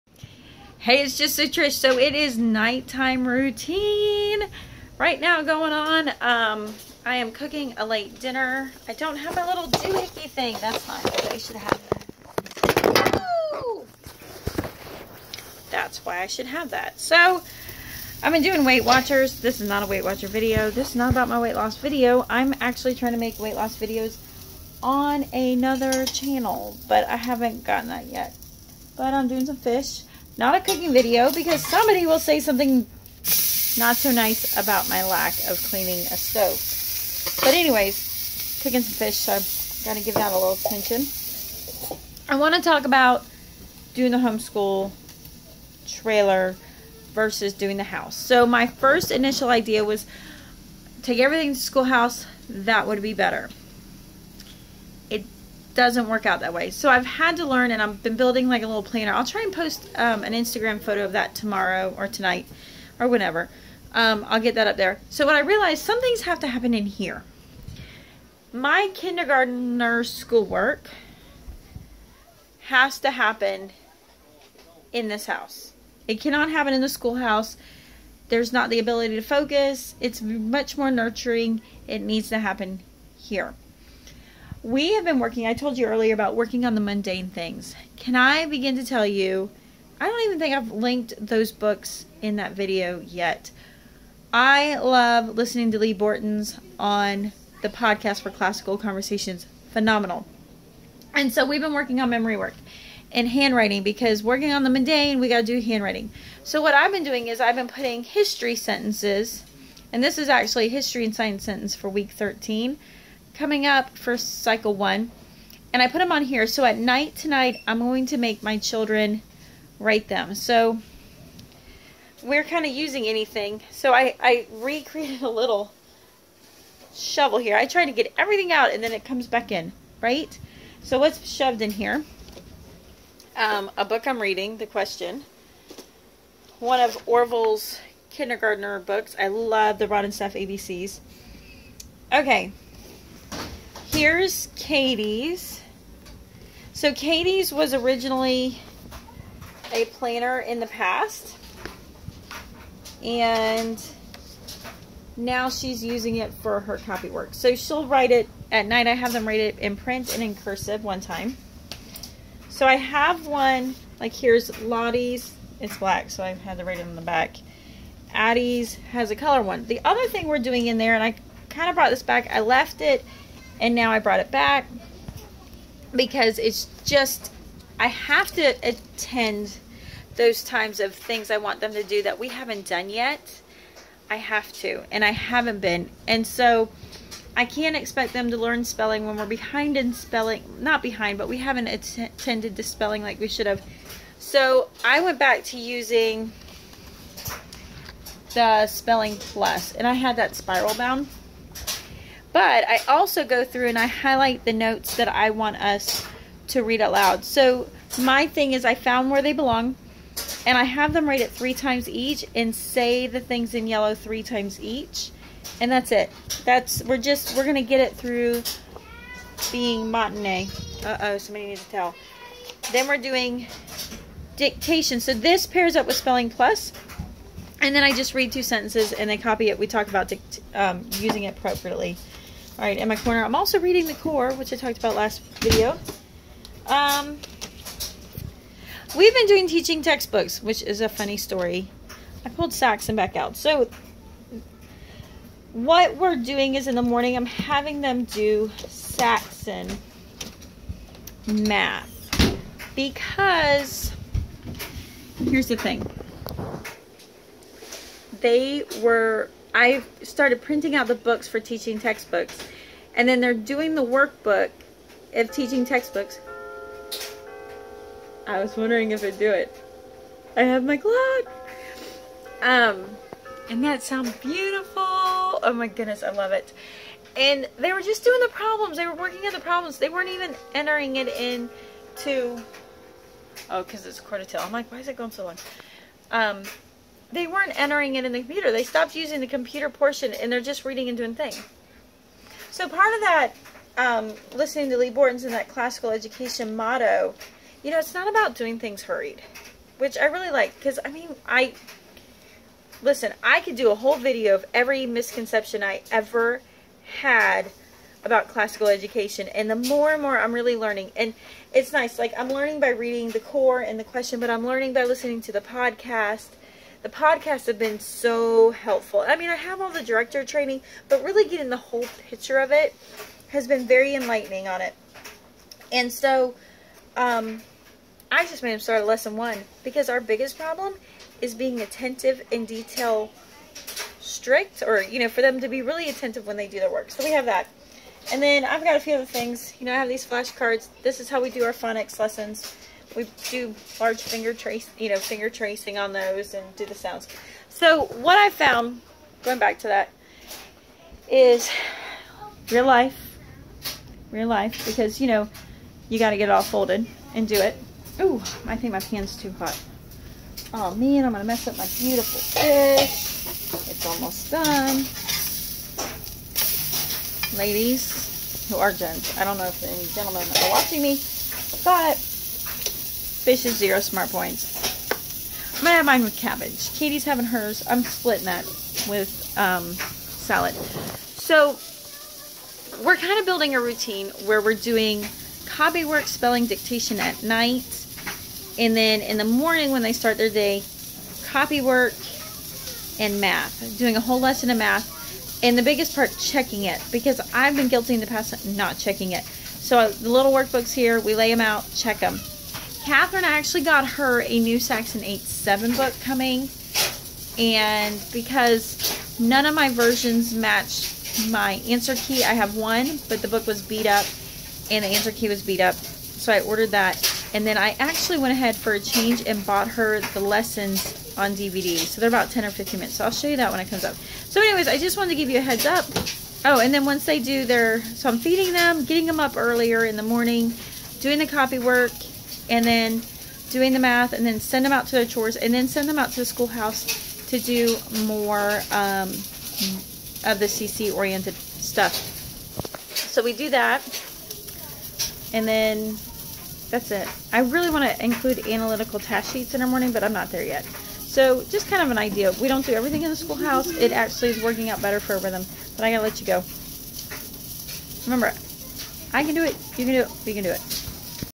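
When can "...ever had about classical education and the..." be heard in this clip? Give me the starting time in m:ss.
5:05.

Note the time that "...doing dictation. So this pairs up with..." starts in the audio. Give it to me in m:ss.
3:42.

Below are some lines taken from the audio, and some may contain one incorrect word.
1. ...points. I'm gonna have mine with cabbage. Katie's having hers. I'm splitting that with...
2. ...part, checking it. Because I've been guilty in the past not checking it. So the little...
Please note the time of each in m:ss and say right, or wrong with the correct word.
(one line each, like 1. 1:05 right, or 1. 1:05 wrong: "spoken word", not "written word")
1. 6:14 right
2. 6:35 right.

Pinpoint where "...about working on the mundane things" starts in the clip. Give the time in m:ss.
1:26.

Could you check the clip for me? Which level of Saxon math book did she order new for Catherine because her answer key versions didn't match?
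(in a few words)
8-7.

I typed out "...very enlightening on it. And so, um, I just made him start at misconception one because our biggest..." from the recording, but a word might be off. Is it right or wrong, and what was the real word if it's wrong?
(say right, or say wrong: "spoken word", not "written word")
wrong: "lesson", not "misconception".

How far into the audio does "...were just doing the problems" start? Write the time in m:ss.
4:37.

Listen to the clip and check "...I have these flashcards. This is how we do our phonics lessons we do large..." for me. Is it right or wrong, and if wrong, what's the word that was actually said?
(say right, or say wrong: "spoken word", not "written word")
right.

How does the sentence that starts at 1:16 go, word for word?
It cannot happen in the schoolhouse.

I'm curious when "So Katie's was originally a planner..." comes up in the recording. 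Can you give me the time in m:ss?
2:26.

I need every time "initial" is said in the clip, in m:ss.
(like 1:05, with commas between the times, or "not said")
0:49.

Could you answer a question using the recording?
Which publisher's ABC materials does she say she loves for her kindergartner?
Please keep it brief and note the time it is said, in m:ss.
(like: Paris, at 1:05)
Rod and Staff, at 2:19.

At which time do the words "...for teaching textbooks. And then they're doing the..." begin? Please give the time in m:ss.
4:21.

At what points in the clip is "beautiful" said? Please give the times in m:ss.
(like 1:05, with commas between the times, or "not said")
4:34, 6:01.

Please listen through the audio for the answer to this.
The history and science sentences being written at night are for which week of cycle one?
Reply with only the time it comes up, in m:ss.
1:51.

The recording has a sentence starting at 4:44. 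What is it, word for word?
I'm like, why is it going so long?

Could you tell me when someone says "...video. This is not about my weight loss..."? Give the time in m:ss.
0:20.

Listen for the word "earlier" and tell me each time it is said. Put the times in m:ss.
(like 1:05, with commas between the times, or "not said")
1:25, 7:09.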